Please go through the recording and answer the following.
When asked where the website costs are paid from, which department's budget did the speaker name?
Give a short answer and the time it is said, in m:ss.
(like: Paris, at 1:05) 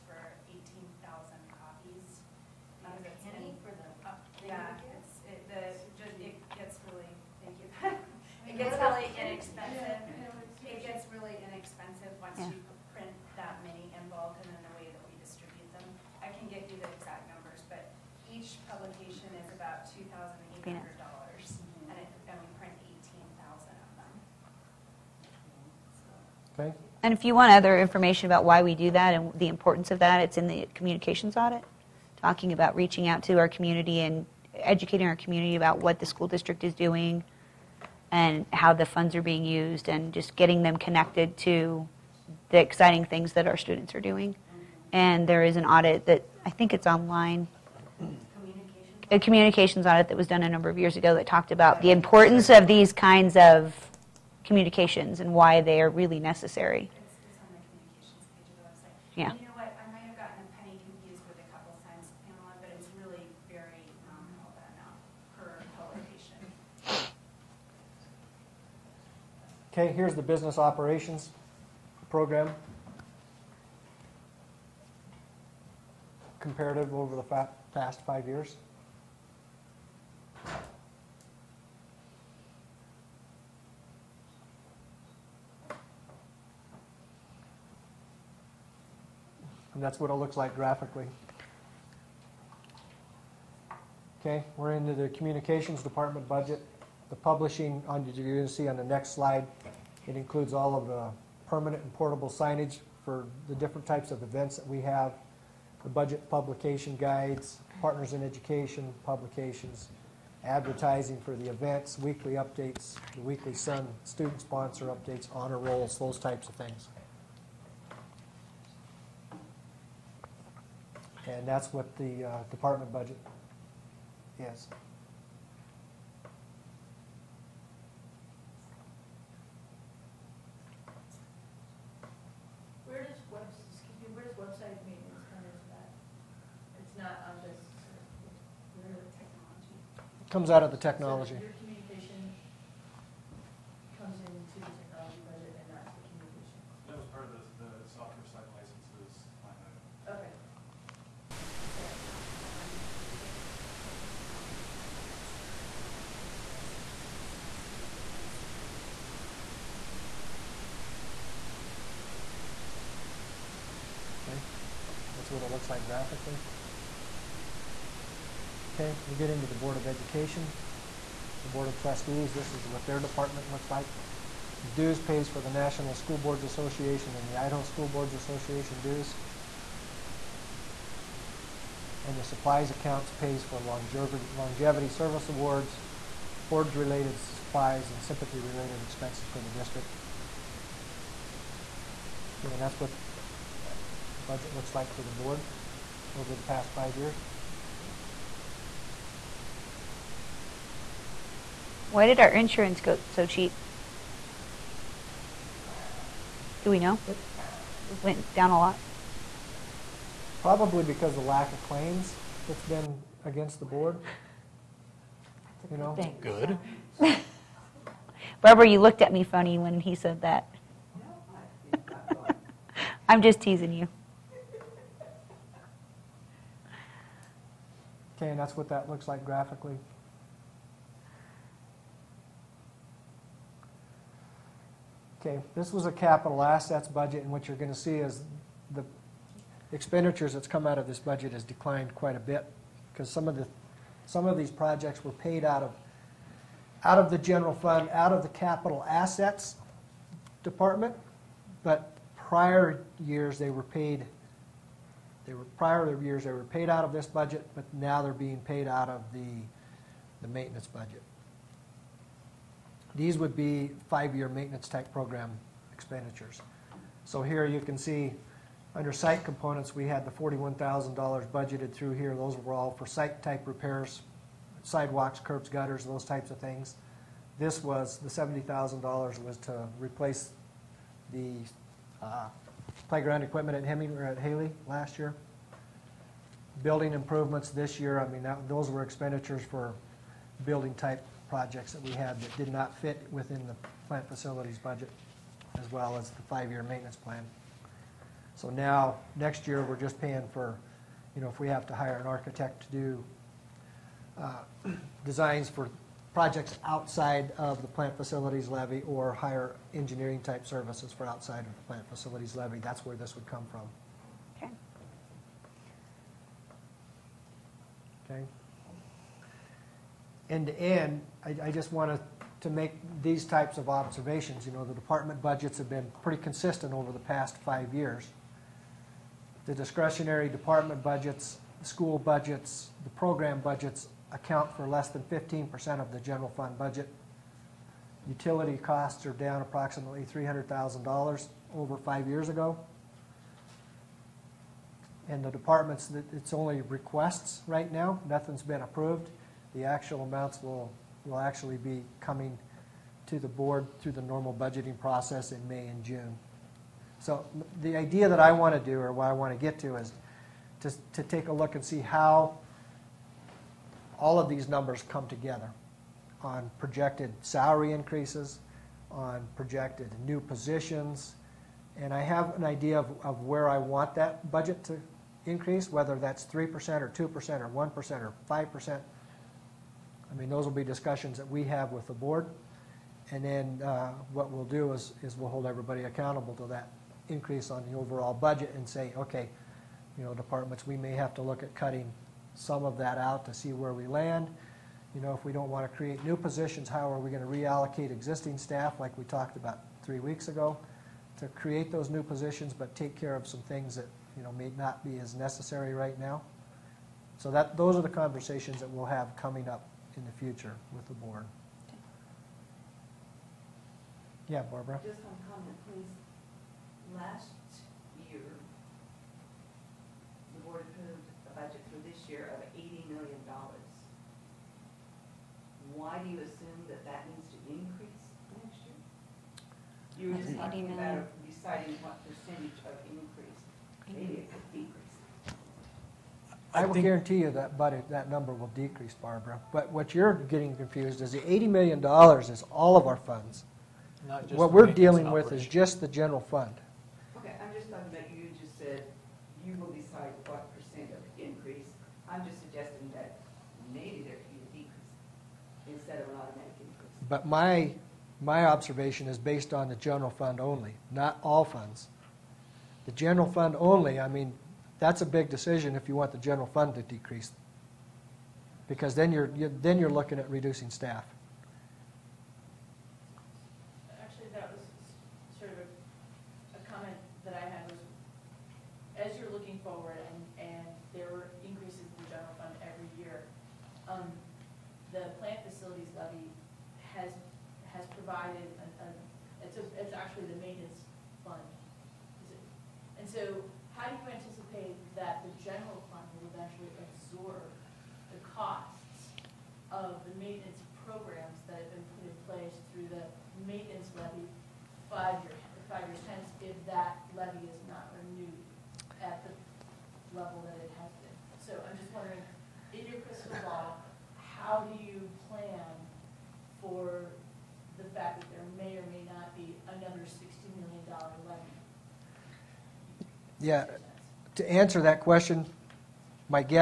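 Technology, at 2:20.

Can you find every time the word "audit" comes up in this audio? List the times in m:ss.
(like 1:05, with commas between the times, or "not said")
0:31, 0:45, 0:49.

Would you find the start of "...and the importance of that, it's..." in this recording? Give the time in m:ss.
0:29.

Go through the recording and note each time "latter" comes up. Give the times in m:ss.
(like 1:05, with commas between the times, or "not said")
not said.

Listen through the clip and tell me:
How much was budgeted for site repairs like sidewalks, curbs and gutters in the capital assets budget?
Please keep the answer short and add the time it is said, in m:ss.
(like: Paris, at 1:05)
$41,000, at 4:30.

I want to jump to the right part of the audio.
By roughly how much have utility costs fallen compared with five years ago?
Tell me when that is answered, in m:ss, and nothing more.
5:40.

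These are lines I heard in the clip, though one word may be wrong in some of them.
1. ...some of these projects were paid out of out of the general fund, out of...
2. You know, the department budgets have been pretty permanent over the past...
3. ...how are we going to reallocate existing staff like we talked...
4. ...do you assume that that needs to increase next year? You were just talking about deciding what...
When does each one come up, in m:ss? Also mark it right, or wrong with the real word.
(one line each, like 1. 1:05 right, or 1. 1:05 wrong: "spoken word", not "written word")
1. 4:04 right
2. 5:24 wrong: "consistent", not "permanent"
3. 6:36 right
4. 7:06 right.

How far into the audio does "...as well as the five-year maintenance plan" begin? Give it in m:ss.
4:55.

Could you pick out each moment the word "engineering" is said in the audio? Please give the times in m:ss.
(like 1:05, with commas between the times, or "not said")
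5:09.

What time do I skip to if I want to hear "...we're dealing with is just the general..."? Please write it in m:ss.
7:24.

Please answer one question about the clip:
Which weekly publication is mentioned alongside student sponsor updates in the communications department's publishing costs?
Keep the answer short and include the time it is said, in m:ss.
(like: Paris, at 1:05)
Sun, at 1:53.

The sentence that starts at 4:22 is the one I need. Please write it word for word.
These would be five-year maintenance type program expenditures.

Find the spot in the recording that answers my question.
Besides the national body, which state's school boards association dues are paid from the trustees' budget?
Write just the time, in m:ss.
2:57.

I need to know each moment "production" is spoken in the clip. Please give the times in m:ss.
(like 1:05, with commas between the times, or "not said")
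not said.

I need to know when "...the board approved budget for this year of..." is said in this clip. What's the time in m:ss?
7:00.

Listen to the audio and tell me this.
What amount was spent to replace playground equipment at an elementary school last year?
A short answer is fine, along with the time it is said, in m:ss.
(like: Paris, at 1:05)
$70,000, at 4:38.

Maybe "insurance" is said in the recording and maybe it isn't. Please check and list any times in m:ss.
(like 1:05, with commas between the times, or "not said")
3:22.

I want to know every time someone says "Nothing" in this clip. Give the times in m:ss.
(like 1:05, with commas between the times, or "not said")
5:48.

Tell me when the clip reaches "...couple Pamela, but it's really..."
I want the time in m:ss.
1:01.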